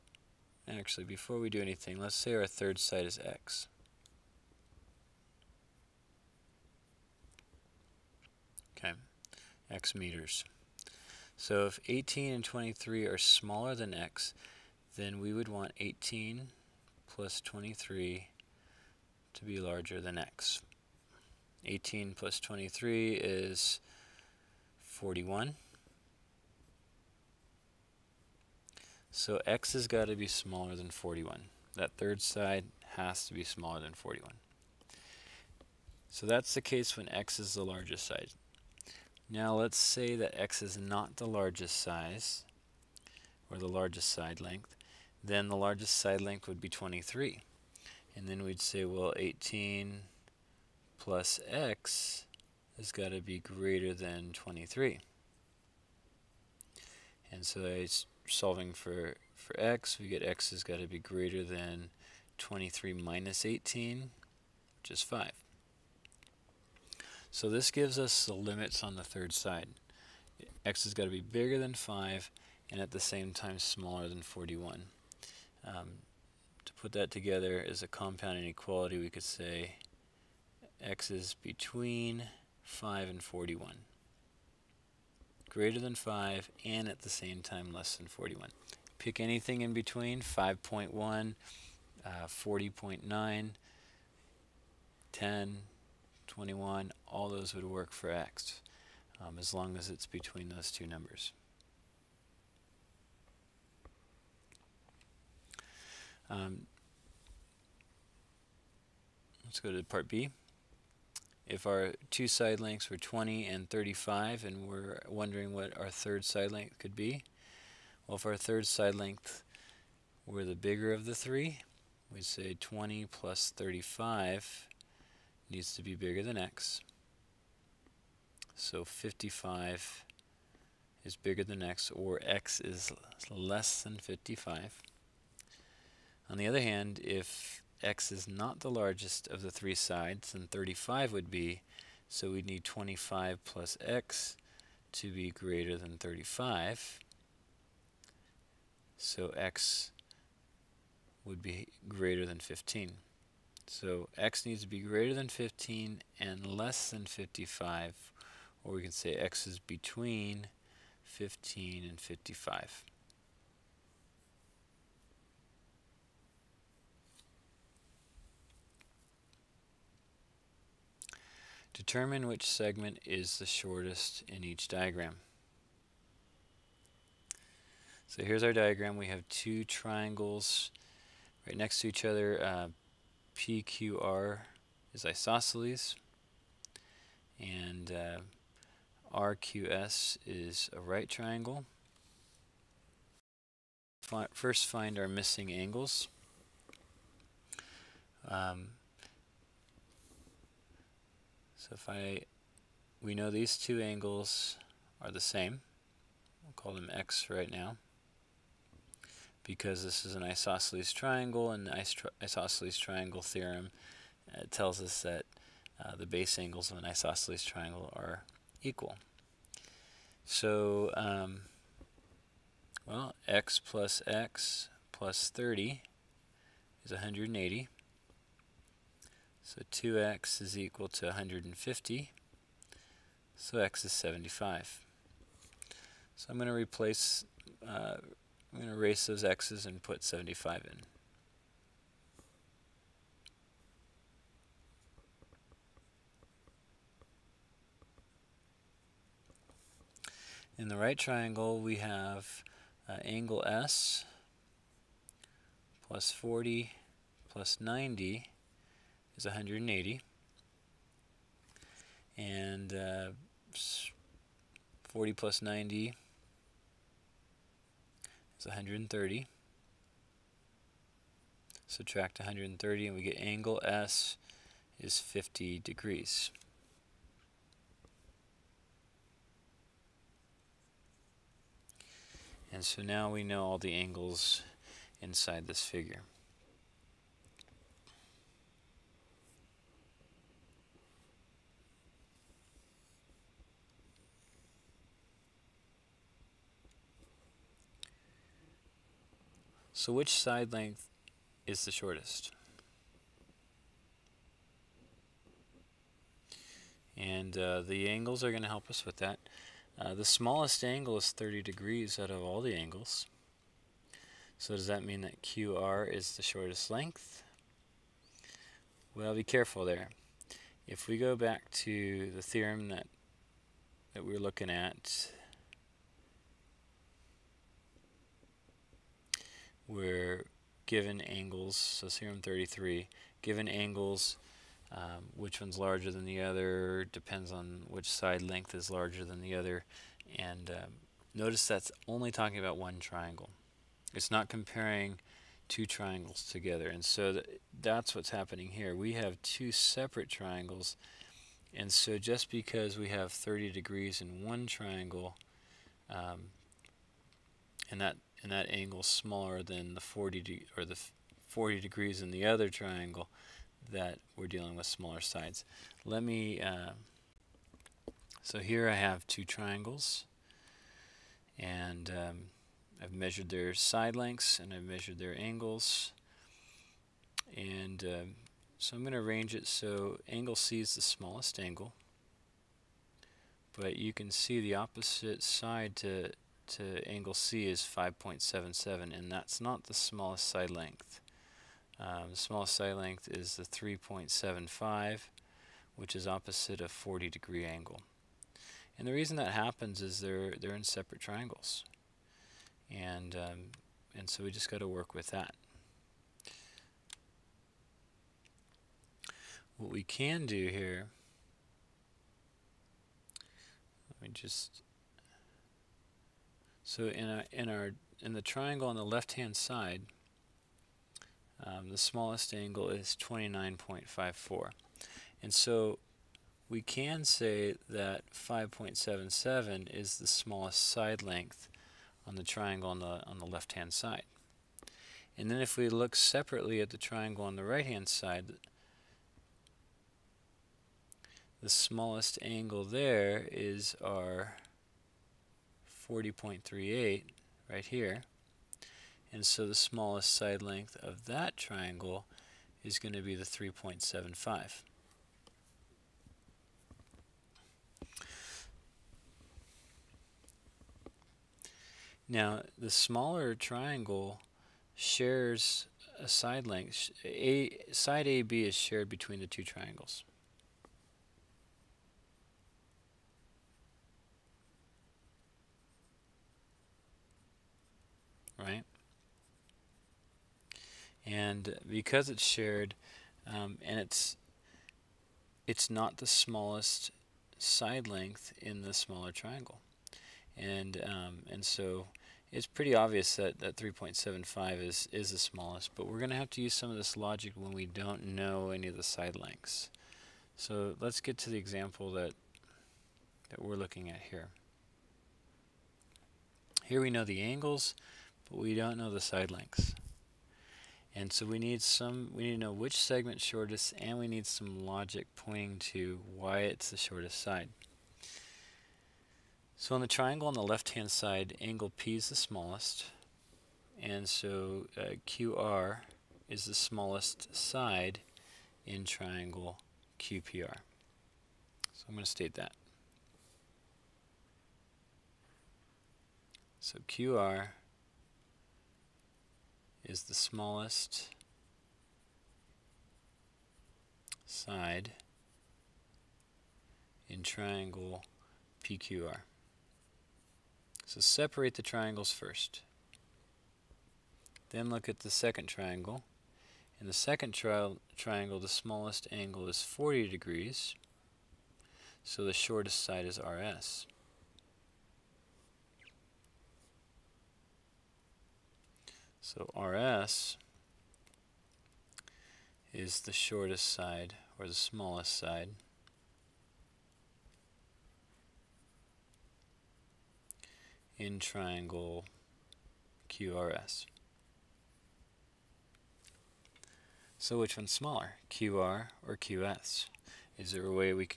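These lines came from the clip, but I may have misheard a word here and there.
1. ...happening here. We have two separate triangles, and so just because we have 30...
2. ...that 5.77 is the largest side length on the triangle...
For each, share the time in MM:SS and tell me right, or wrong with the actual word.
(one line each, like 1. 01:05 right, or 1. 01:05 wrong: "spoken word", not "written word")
1. 05:48 right
2. 07:07 wrong: "smallest", not "largest".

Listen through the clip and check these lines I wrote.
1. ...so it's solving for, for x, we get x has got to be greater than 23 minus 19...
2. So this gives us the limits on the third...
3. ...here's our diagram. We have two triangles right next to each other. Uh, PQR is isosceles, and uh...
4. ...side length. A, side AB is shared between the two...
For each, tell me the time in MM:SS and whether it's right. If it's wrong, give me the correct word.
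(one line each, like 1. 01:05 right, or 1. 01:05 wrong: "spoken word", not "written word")
1. 00:57 wrong: "18", not "19"
2. 01:07 right
3. 02:58 right
4. 07:46 right.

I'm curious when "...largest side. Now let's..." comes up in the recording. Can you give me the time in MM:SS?
00:37.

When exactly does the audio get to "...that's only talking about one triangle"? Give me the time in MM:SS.
05:41.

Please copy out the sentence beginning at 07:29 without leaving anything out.
And so the smallest side length of that triangle is going to be the 3.75.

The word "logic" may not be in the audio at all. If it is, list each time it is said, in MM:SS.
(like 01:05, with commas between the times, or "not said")
08:16, 08:34.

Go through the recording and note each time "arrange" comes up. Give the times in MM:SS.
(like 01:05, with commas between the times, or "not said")
06:18.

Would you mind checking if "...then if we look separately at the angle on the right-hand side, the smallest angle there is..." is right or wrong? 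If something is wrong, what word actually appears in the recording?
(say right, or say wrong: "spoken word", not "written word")
wrong: "triangle", not "angle".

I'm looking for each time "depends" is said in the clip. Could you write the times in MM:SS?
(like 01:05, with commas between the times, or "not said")
05:36.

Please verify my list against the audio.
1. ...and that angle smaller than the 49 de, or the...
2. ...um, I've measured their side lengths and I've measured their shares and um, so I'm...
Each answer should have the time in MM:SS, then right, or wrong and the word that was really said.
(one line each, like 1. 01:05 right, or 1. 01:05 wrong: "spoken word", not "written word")
1. 05:58 wrong: "40", not "49"
2. 06:11 wrong: "angles", not "shares".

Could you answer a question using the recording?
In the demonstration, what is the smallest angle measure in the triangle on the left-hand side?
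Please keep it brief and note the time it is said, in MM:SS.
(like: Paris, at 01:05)
29.54, at 07:03.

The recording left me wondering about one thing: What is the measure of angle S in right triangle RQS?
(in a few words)
50 degrees.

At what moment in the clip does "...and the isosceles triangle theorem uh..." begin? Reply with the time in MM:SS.
03:31.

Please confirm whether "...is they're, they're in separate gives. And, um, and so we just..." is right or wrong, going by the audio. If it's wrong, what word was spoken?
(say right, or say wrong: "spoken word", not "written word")
wrong: "triangles", not "gives".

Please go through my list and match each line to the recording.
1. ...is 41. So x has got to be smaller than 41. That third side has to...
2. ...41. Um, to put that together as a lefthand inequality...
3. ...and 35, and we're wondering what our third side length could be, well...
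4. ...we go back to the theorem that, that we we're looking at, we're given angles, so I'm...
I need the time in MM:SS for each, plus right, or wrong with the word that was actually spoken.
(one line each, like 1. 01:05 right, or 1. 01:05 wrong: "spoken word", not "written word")
1. 00:23 right
2. 01:14 wrong: "compound", not "lefthand"
3. 01:53 right
4. 05:20 right.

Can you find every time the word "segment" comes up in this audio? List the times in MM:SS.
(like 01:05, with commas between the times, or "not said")
02:52, 08:32.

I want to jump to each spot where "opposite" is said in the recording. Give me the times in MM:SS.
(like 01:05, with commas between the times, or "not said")
06:24, 06:36.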